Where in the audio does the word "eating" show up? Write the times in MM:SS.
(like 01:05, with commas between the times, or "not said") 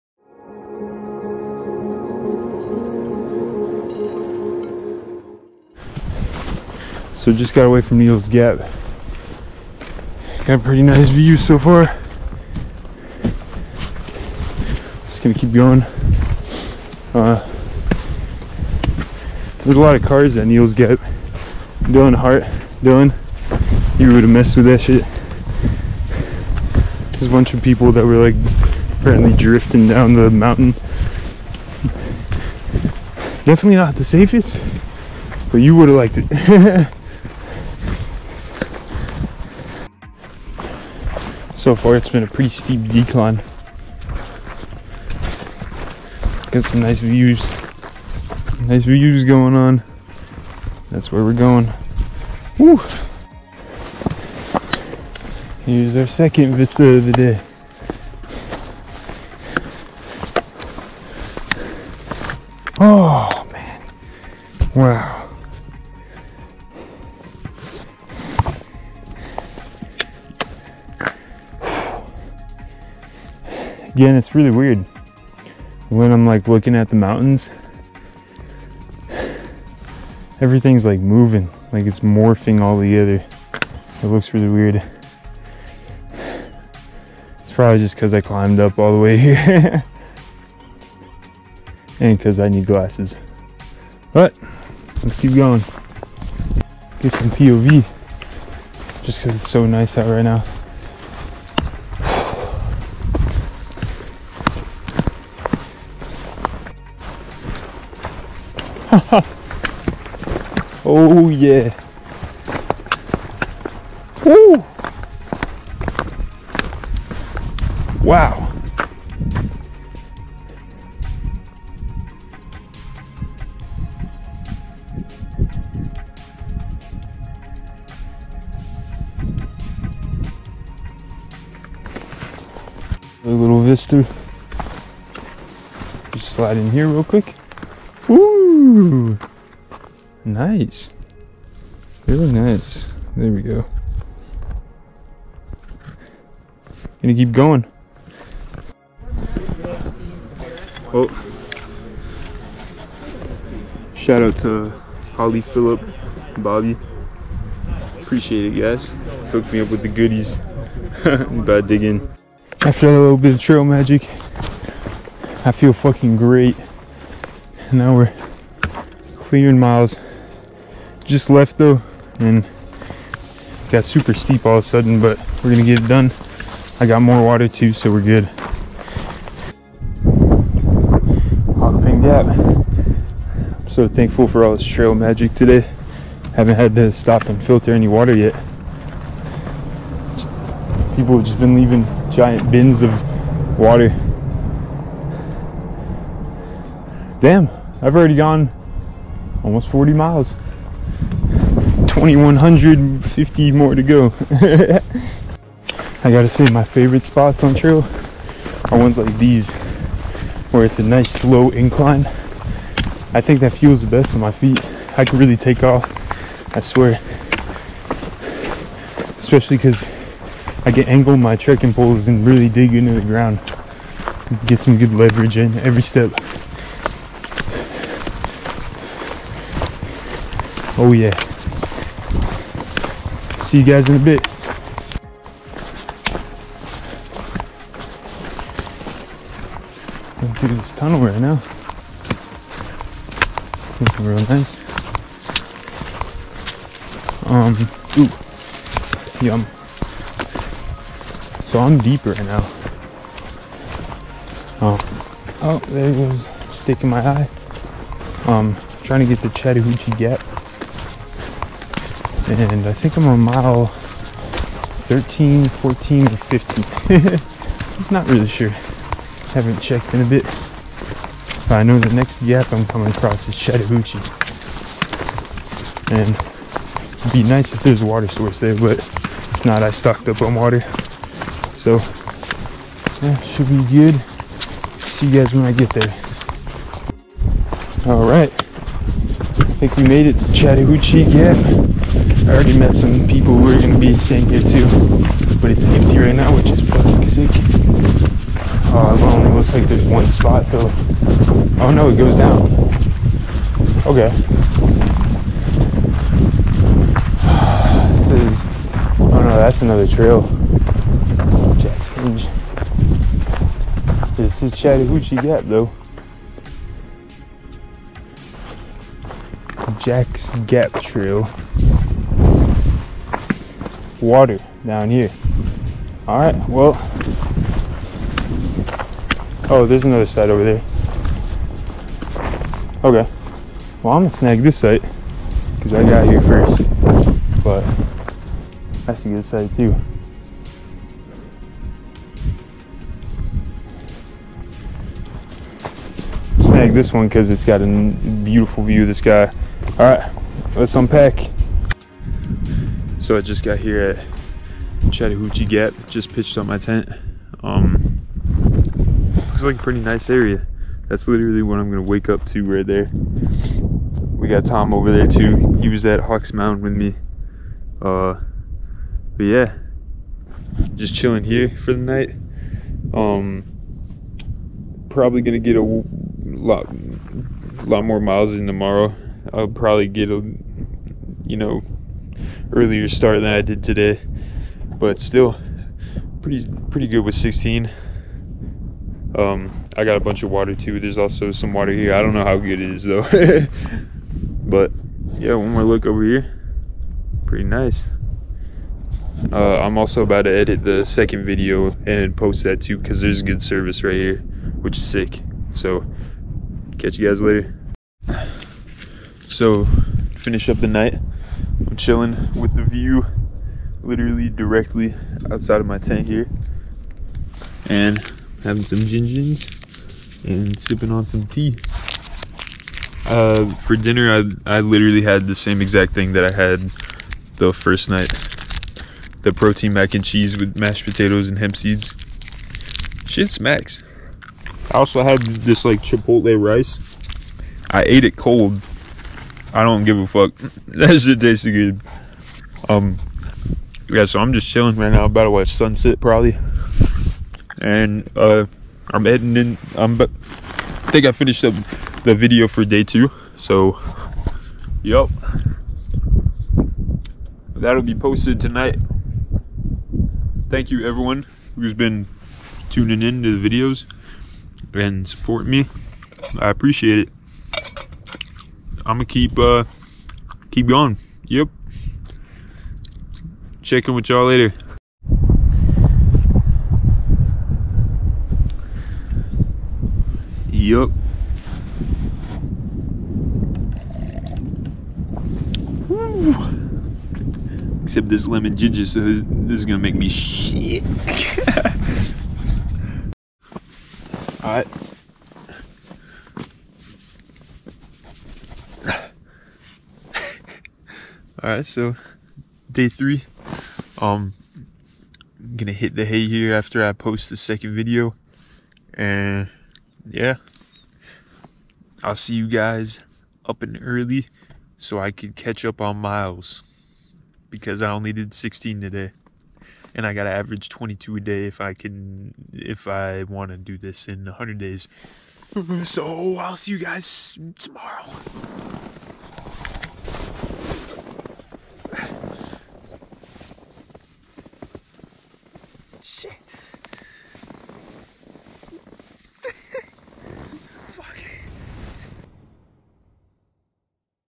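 not said.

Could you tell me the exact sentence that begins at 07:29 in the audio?
I'm, but I think I finished up the video for day two.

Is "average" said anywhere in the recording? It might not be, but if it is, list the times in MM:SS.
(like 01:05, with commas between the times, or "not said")
08:40.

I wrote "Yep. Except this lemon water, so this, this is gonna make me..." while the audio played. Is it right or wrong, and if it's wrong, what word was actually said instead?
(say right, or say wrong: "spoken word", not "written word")
wrong: "ginger", not "water".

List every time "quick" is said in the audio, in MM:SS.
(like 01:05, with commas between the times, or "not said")
02:17.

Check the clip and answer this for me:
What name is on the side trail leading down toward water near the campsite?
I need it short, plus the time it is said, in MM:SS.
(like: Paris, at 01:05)
Jack's Gap Trail, at 05:19.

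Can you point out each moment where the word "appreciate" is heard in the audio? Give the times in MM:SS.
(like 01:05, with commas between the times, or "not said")
02:38, 07:46.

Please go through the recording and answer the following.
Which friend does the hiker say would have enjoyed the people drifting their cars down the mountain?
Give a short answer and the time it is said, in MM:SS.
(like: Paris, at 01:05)
Dylan Hart, at 00:21.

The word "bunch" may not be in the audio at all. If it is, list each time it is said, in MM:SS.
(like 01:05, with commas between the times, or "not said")
00:27, 06:29.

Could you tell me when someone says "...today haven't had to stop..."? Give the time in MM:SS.
03:05.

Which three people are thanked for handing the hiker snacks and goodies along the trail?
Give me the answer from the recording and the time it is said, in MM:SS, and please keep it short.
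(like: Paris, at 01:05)
Holly, Phillip, Bobby, at 02:35.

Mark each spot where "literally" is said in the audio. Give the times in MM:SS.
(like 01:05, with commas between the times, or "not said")
06:01, 06:53, 07:04.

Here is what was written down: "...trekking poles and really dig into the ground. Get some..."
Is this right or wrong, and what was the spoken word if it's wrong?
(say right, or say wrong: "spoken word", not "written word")
right.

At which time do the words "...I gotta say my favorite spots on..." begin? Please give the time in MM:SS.
03:26.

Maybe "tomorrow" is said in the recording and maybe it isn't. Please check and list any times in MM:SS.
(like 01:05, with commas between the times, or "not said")
06:18, 08:47.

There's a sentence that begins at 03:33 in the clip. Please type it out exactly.
I think that feels the best on my feet.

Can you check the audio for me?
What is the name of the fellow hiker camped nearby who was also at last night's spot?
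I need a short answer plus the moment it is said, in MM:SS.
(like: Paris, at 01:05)
Tom, at 06:04.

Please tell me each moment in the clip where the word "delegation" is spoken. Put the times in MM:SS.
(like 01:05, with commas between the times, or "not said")
not said.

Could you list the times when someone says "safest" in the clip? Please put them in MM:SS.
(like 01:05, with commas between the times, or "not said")
00:34.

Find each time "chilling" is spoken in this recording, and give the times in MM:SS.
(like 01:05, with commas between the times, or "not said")
06:10, 06:51, 07:24.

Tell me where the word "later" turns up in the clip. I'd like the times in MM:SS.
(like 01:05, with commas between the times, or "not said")
06:47, 07:54.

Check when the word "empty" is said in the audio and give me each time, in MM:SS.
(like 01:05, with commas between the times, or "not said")
04:55.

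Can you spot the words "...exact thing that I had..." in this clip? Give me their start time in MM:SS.
07:05.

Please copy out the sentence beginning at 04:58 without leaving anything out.
Uh, it only looks like there's one spot though.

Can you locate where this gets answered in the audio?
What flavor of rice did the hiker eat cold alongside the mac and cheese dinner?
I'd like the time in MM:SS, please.
07:15.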